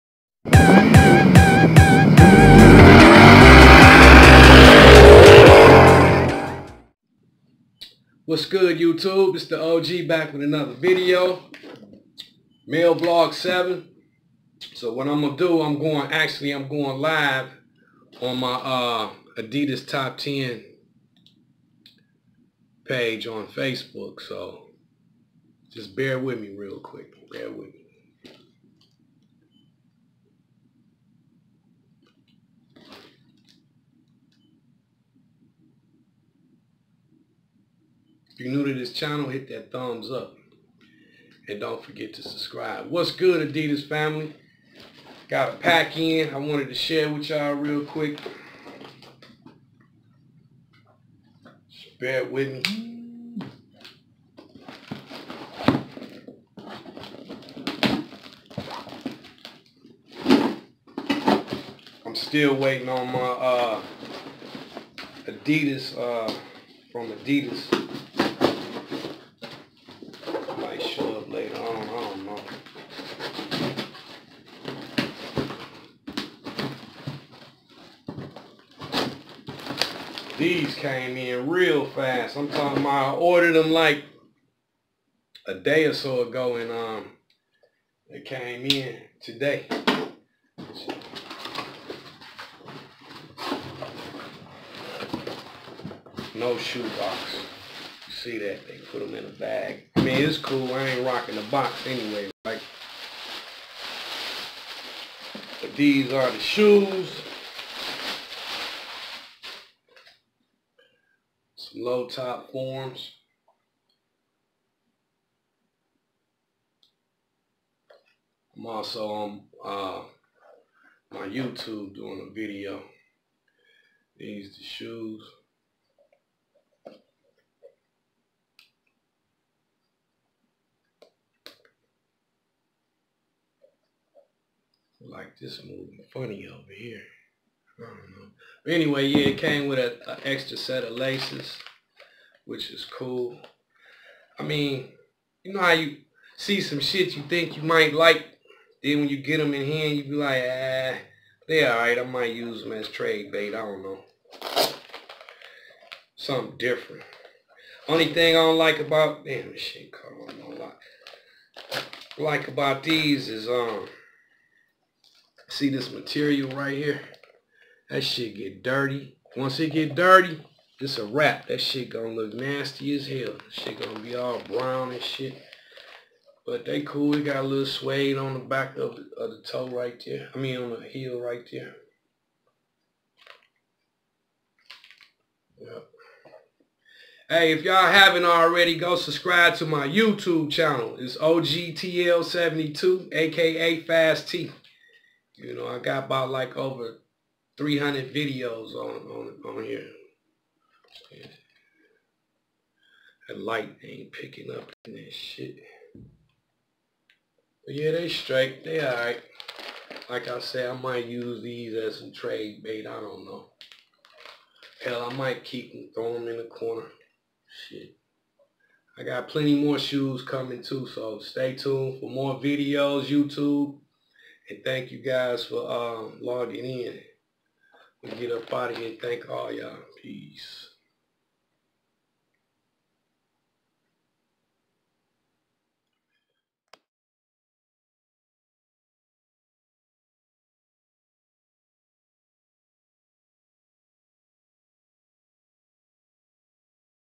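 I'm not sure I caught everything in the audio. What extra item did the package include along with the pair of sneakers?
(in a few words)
extra set of laces.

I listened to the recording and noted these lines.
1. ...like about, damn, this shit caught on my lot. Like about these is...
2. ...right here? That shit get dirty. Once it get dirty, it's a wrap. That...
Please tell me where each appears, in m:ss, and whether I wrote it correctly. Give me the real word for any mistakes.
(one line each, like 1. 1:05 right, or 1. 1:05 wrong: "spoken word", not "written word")
1. 2:38 right
2. 2:46 right.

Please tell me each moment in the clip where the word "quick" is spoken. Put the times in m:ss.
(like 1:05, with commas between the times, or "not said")
0:26, 0:47.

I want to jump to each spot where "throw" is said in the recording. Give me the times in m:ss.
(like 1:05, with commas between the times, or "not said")
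3:35.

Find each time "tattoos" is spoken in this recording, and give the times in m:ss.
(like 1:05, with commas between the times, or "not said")
not said.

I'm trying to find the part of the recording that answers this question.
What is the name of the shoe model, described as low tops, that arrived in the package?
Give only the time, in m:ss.
1:52.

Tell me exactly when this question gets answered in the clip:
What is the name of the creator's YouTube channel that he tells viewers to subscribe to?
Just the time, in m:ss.
3:11.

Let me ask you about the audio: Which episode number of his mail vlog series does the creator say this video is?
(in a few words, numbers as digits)
7.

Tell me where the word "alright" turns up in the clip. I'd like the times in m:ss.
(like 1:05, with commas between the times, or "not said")
2:31, 3:28.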